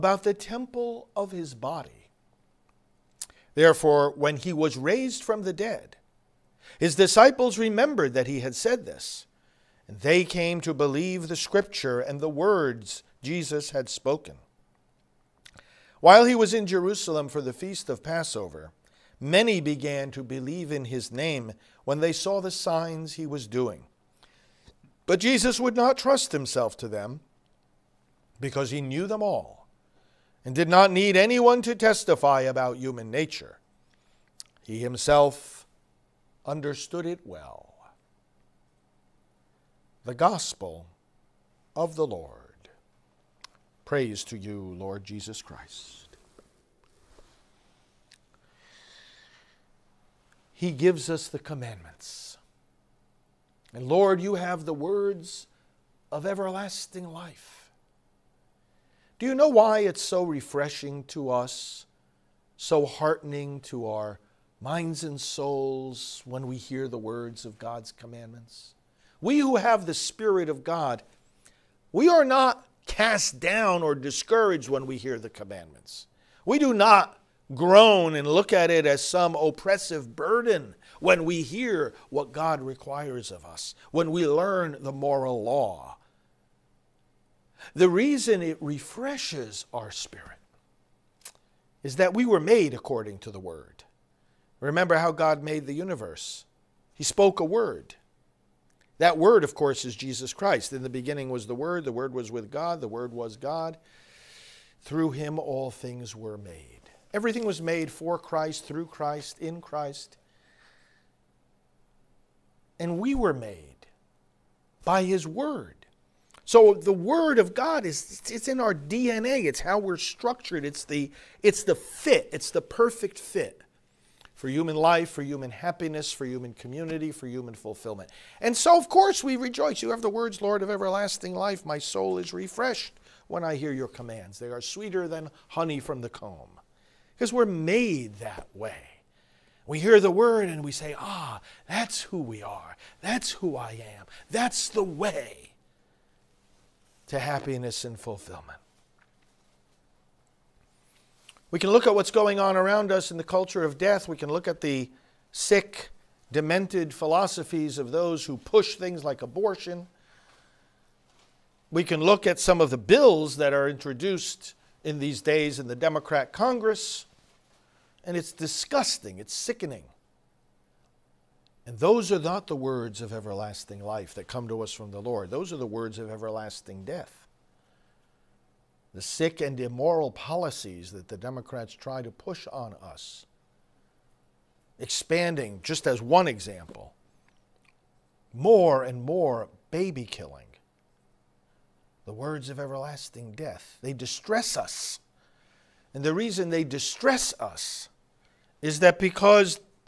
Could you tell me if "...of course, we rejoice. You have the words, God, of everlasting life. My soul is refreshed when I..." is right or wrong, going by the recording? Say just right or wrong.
wrong.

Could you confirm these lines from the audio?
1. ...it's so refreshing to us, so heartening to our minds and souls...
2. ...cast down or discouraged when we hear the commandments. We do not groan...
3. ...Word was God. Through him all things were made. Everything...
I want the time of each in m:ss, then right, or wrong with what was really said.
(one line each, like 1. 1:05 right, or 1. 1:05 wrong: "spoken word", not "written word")
1. 0:59 right
2. 1:12 right
3. 1:42 right.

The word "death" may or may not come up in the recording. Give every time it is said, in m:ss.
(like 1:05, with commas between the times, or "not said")
2:33, 2:56, 3:13.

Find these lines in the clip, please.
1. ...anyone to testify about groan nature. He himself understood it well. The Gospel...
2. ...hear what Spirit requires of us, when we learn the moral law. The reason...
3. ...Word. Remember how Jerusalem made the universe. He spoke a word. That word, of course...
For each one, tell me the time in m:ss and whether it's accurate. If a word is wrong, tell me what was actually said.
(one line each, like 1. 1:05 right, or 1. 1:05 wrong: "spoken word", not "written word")
1. 0:31 wrong: "human", not "groan"
2. 1:21 wrong: "God", not "Spirit"
3. 1:33 wrong: "God", not "Jerusalem".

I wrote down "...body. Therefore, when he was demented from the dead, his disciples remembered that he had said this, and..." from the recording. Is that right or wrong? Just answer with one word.
wrong.